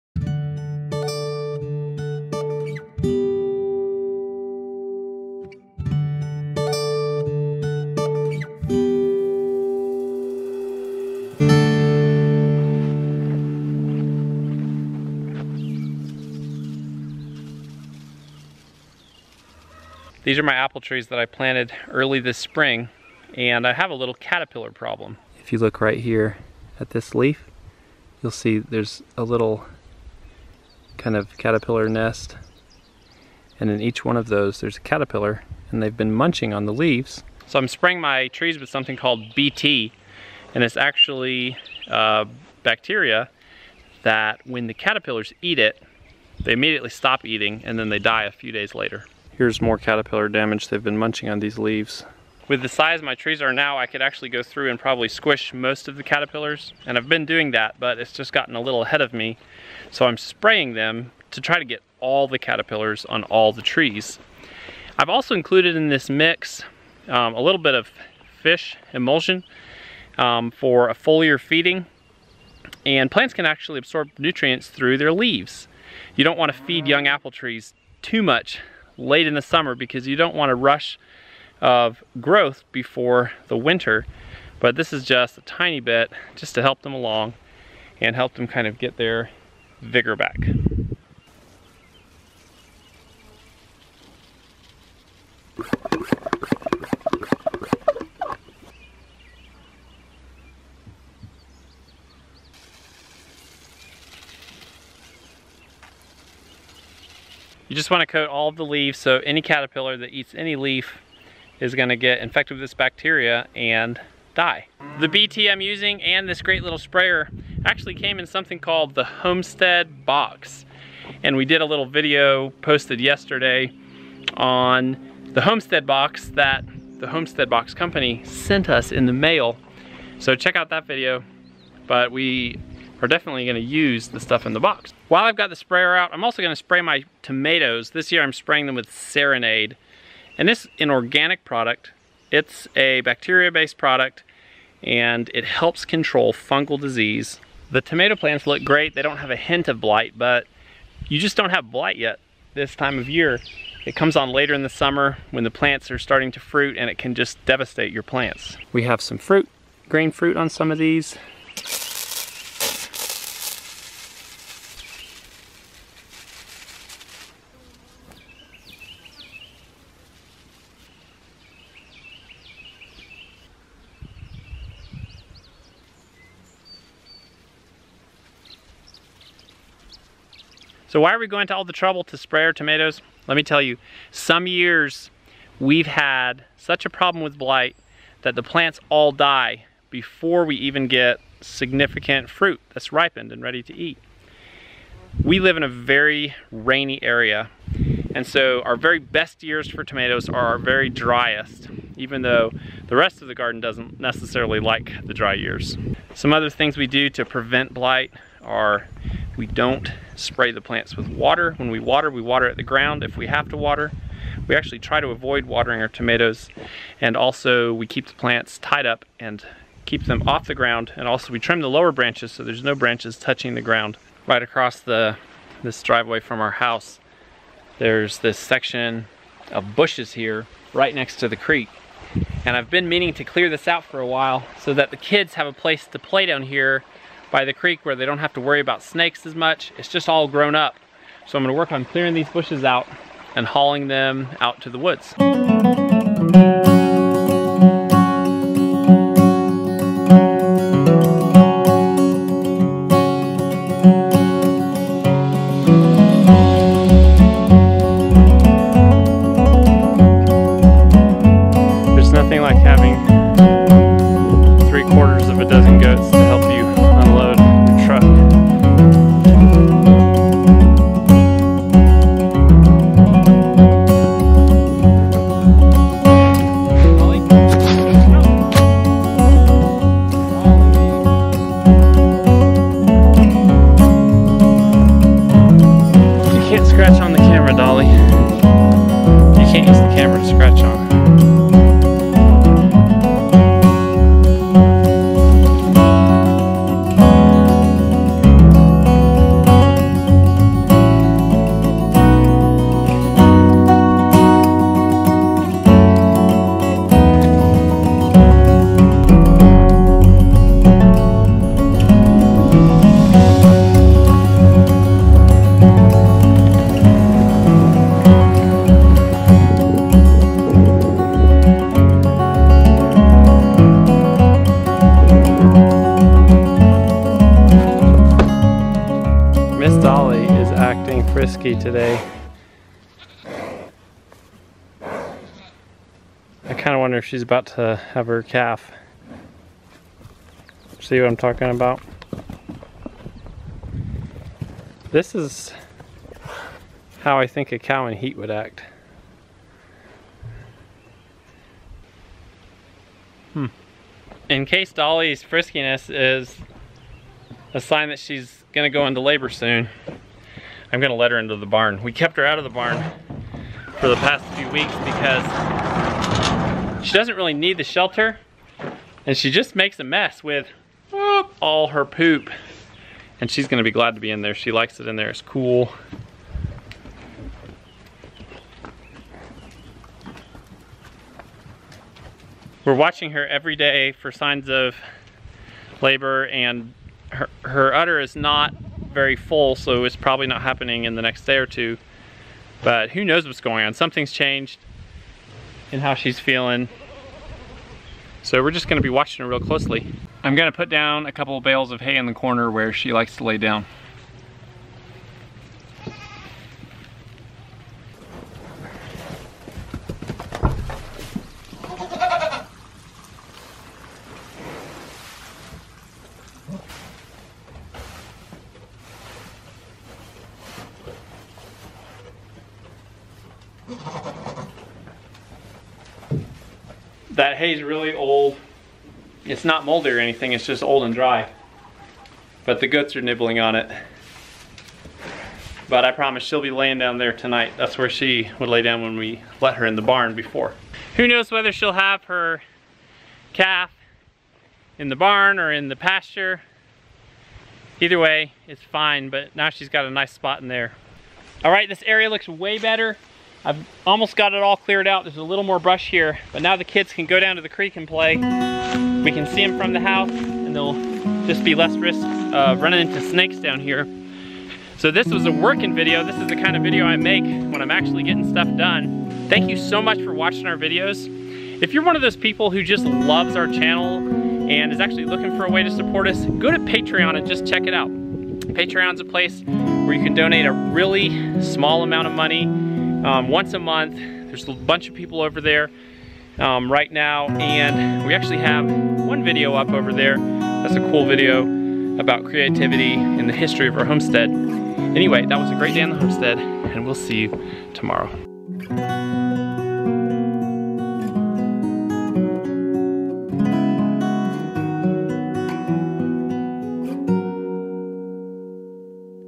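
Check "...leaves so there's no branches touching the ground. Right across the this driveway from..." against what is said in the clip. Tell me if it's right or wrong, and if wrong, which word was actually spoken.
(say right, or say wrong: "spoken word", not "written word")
wrong: "branches", not "leaves".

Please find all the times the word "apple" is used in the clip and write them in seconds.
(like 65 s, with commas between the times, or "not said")
20 s, 77 s.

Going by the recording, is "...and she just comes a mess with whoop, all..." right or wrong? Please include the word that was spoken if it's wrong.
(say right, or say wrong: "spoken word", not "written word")
wrong: "makes", not "comes".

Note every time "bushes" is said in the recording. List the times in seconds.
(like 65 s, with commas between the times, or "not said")
229 s, 242 s.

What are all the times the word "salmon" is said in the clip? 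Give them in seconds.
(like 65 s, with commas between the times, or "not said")
not said.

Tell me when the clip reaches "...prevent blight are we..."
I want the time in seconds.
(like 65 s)
207 s.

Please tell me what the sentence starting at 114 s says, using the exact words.
The BT I'm using and this great little sprayer actually came in something called the Homestead Box.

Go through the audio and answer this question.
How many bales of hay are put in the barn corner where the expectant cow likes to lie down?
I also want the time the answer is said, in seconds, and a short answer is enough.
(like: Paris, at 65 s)
2, at 401 s.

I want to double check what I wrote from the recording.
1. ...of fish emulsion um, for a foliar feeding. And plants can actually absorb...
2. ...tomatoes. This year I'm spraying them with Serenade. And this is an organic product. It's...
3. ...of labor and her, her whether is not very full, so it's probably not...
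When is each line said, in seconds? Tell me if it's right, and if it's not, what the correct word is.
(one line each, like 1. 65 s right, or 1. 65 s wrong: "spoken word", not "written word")
1. 67 s right
2. 137 s right
3. 384 s wrong: "udder", not "whether".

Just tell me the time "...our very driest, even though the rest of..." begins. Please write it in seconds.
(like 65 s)
200 s.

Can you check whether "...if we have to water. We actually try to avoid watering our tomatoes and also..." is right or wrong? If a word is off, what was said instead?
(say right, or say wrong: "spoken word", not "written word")
right.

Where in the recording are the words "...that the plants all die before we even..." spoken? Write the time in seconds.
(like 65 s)
188 s.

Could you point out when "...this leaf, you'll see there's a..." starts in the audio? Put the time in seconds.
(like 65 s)
26 s.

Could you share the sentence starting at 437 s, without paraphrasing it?
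That's where she would lay down when we let her in the barn before.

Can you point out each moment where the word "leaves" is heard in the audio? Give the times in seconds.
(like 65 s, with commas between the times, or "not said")
36 s, 51 s, 75 s, 108 s.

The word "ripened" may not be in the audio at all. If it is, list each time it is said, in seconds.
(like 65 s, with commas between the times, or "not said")
192 s.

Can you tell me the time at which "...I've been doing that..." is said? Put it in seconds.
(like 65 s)
56 s.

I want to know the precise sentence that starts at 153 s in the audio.
It comes on later in the summer when the plants are starting to fruit and it can just devastate your plants.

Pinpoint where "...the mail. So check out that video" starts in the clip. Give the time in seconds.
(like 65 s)
129 s.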